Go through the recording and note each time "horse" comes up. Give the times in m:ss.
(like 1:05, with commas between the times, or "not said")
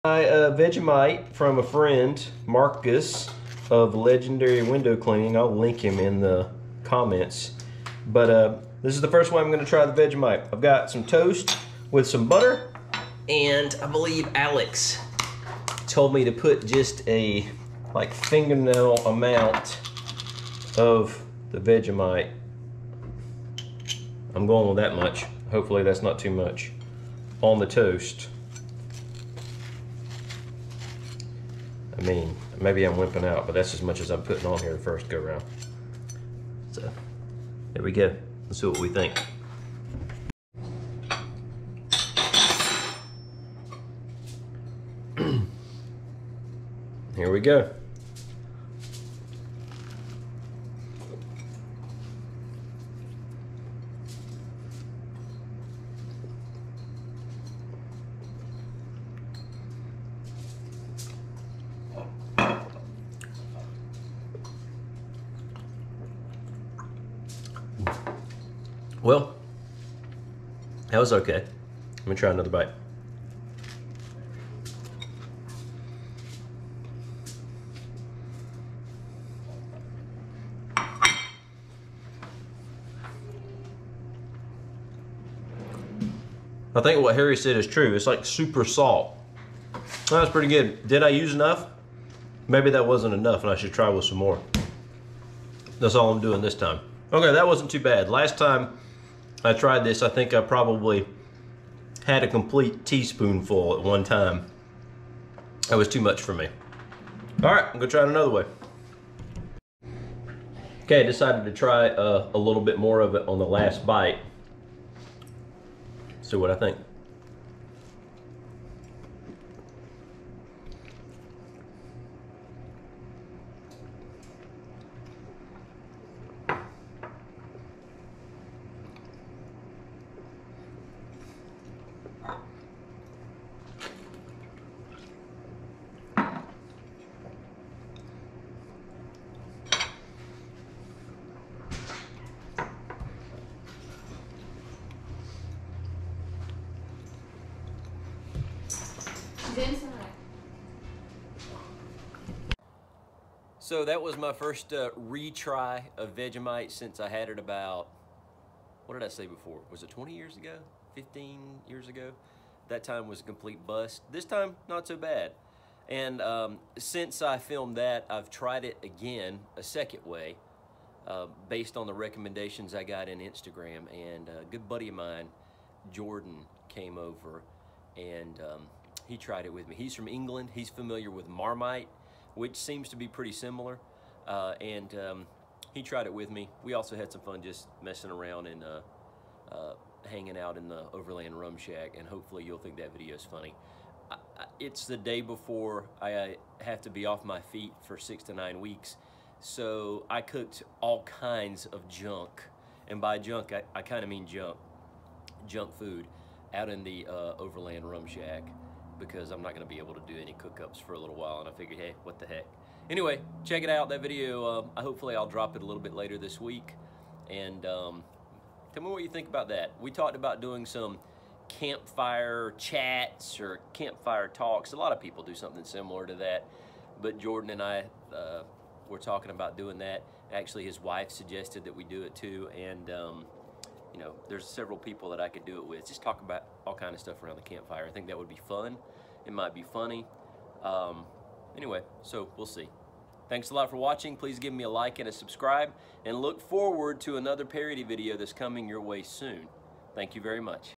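not said.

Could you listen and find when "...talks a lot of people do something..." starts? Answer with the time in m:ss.
3:44.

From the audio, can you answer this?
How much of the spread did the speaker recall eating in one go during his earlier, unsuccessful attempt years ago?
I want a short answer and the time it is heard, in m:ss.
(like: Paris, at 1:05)
a complete teaspoonful, at 1:42.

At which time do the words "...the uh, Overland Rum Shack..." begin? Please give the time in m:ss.
3:26.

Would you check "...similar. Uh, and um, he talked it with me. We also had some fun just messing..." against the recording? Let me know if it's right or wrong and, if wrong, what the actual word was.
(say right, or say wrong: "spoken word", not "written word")
wrong: "tried", not "talked".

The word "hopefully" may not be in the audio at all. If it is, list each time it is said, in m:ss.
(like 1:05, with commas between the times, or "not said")
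0:25, 3:12, 3:34.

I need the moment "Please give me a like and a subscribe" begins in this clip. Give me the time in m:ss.
4:04.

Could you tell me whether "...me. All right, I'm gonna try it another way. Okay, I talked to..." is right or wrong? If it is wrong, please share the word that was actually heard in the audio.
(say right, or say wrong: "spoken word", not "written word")
wrong: "decided", not "talked".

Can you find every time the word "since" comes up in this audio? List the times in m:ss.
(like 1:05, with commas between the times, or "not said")
2:36, 2:46.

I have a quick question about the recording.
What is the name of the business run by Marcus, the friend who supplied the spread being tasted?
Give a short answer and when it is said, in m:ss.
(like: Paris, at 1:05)
Legendary Window Cleaning, at 0:03.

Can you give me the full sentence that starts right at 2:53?
And uh, a good buddy of mine, Jordan, came over and um, he tried it with me.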